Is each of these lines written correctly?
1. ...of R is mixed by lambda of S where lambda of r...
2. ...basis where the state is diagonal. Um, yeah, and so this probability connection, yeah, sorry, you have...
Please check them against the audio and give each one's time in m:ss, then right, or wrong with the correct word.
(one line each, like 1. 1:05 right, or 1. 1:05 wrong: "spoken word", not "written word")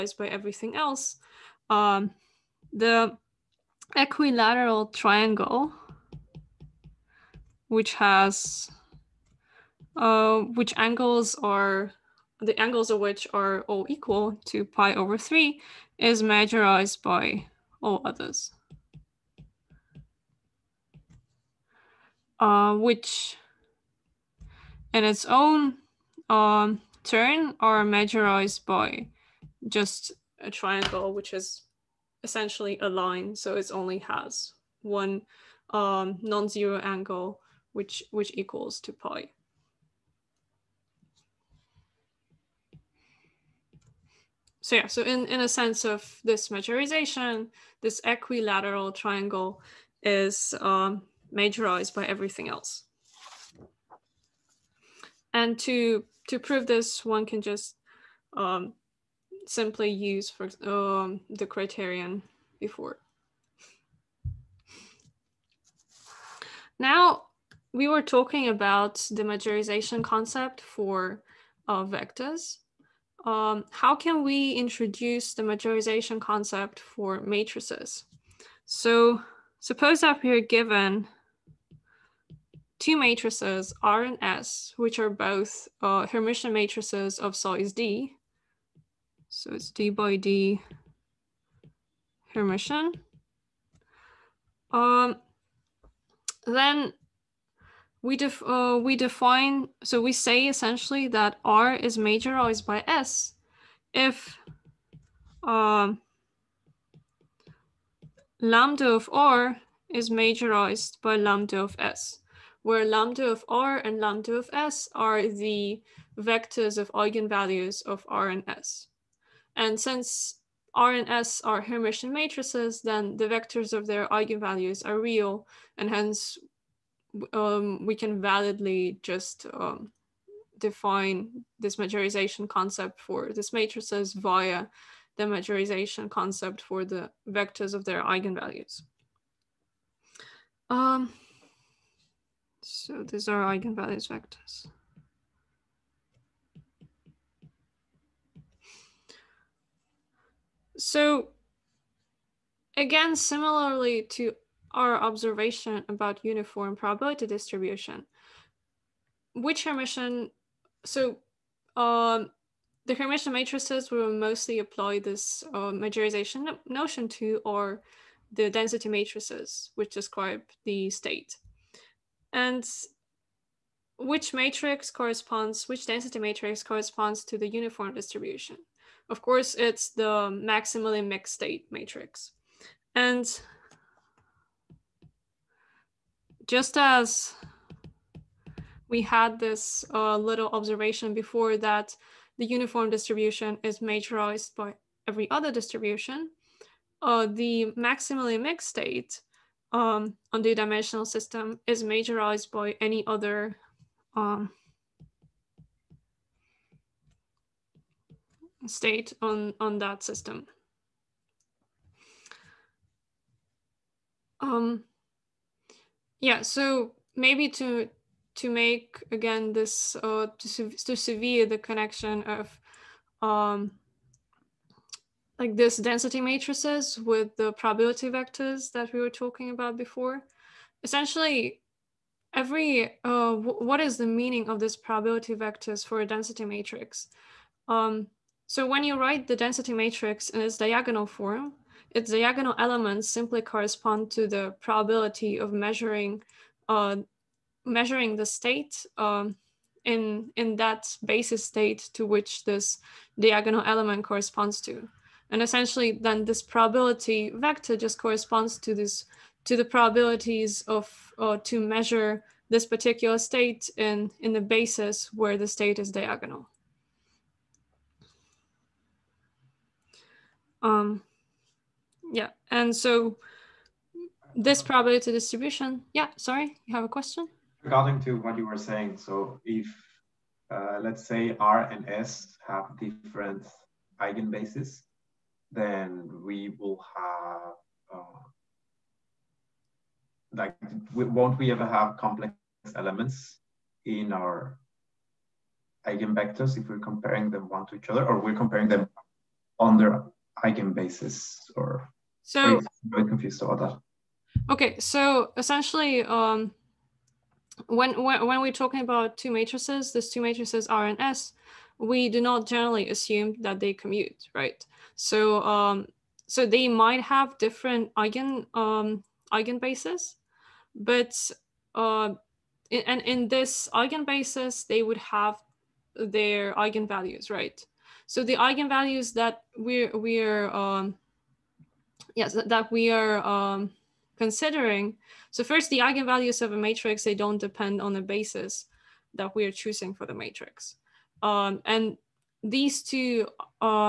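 1. 1:48 wrong: "majorized", not "mixed"
2. 4:24 wrong: "distribution", not "connection".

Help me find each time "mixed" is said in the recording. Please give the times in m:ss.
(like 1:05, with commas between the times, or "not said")
3:01, 3:18.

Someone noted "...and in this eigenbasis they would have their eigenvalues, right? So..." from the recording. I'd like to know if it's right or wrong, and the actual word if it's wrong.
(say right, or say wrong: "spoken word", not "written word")
right.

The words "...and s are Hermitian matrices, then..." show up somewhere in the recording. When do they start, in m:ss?
2:00.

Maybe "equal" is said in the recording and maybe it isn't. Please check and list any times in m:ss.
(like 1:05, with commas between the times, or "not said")
0:13, 0:38.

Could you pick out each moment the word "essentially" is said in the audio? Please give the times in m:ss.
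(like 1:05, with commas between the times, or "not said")
0:32, 1:40, 3:50, 4:15, 5:05.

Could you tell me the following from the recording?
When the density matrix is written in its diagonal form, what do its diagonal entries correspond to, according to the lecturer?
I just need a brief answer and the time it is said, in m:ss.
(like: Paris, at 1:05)
probability of measuring, at 4:04.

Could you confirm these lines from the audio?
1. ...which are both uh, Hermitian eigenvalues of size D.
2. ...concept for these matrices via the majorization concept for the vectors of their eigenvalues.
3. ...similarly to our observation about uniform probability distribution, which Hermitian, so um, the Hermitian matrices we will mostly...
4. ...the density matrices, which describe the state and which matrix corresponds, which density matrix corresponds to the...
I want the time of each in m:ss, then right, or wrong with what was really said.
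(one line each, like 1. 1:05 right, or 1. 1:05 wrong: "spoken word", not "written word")
1. 1:24 wrong: "matrices", not "eigenvalues"
2. 2:12 right
3. 2:33 right
4. 2:48 right.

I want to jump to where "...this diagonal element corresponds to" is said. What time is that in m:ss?
4:12.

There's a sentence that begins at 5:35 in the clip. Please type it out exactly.
So first, the eigenvalues of a matrix they don't depend on the basis that we are choosing for the matrix.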